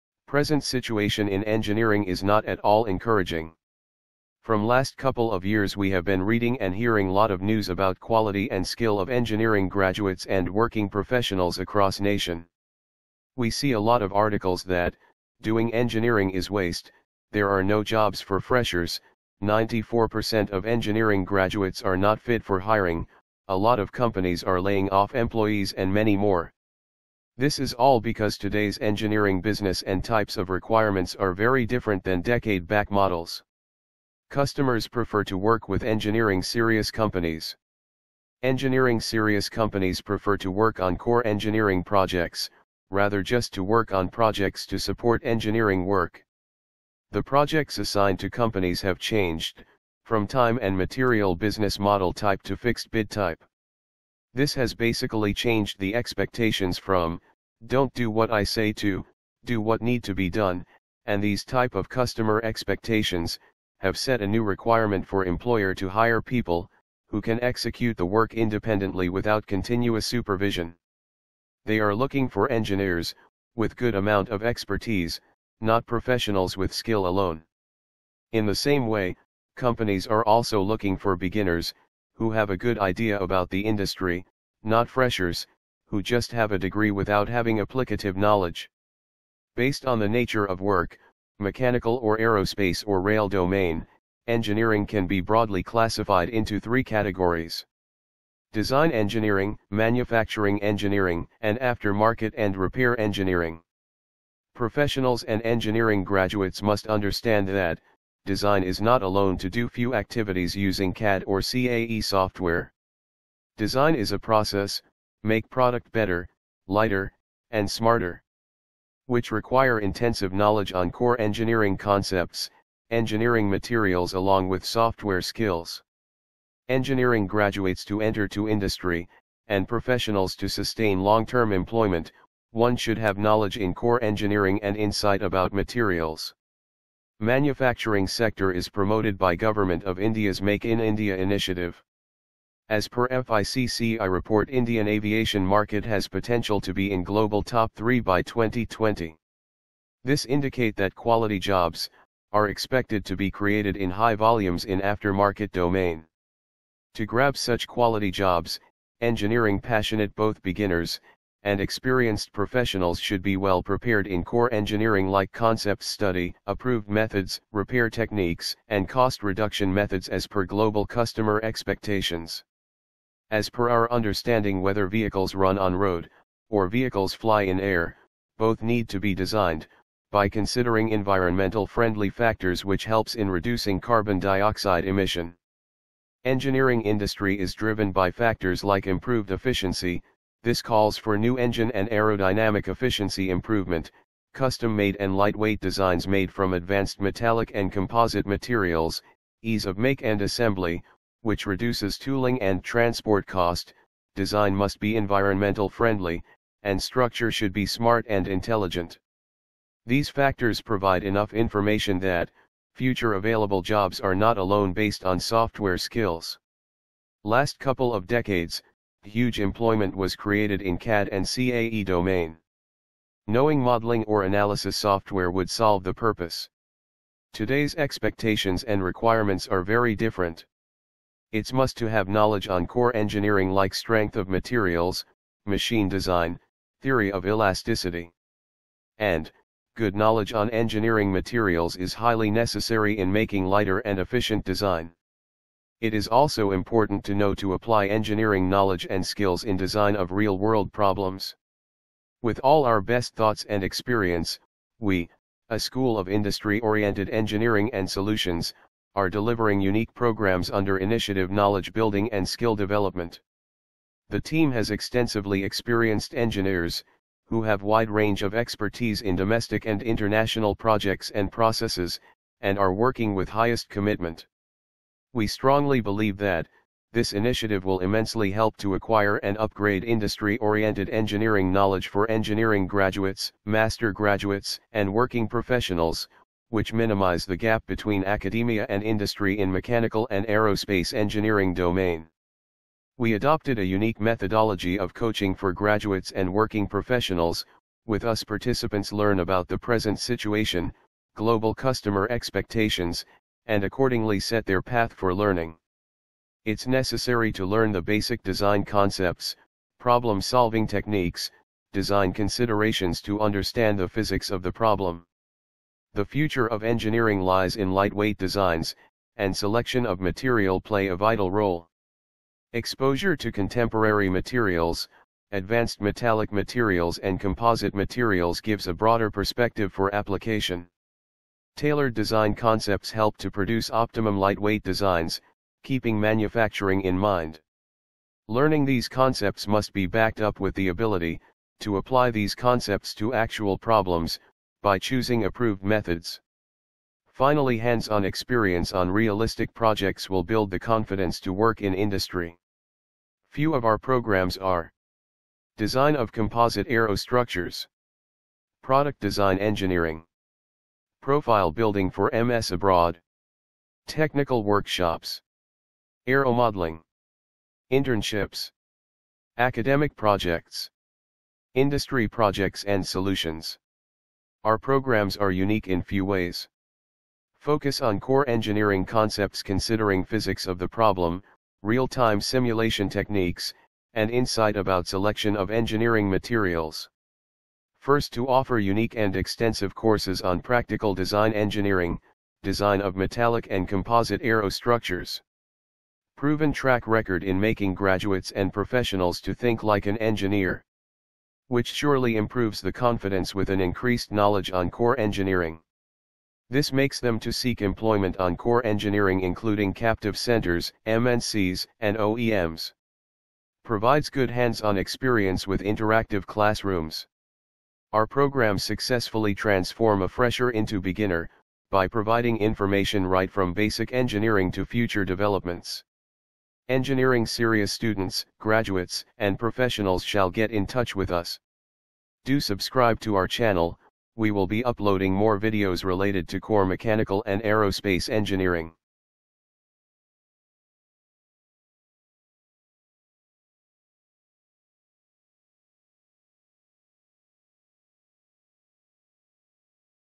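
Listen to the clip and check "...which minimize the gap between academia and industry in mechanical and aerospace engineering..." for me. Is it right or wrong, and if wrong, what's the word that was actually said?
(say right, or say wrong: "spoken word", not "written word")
right.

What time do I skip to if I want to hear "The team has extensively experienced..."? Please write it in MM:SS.
04:24.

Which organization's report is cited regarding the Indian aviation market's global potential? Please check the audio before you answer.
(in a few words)
FICCI.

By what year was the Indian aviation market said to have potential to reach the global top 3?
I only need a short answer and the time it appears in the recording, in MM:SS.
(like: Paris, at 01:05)
2020, at 02:28.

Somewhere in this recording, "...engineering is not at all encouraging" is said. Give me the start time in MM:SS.
00:01.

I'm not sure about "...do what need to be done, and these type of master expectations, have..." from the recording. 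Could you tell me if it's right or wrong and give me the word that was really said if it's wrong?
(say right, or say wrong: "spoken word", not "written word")
wrong: "customer", not "master".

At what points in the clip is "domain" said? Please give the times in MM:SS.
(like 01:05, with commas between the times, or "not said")
01:33, 02:35, 03:41, 04:51.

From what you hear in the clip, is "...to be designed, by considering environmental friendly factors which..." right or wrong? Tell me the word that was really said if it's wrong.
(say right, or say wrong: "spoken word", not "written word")
right.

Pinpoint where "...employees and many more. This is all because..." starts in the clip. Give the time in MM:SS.
00:25.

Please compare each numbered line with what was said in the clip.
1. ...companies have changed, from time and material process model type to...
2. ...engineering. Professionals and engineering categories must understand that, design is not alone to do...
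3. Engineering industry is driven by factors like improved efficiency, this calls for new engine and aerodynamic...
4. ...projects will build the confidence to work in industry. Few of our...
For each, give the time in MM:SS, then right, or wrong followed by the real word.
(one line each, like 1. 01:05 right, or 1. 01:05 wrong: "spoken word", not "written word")
1. 00:48 wrong: "business", not "process"
2. 01:42 wrong: "graduates", not "categories"
3. 03:06 right
4. 05:49 right.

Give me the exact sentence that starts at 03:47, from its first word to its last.
Today's expectations and requirements are very different.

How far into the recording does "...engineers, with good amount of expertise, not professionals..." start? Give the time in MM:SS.
01:12.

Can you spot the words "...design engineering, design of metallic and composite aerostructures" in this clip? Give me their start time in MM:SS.
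06:30.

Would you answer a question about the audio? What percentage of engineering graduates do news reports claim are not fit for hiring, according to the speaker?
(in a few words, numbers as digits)
94%.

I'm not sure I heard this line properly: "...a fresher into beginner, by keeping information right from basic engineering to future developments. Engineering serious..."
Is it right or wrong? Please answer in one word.
wrong.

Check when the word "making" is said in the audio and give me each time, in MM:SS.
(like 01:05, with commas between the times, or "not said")
04:03, 06:37.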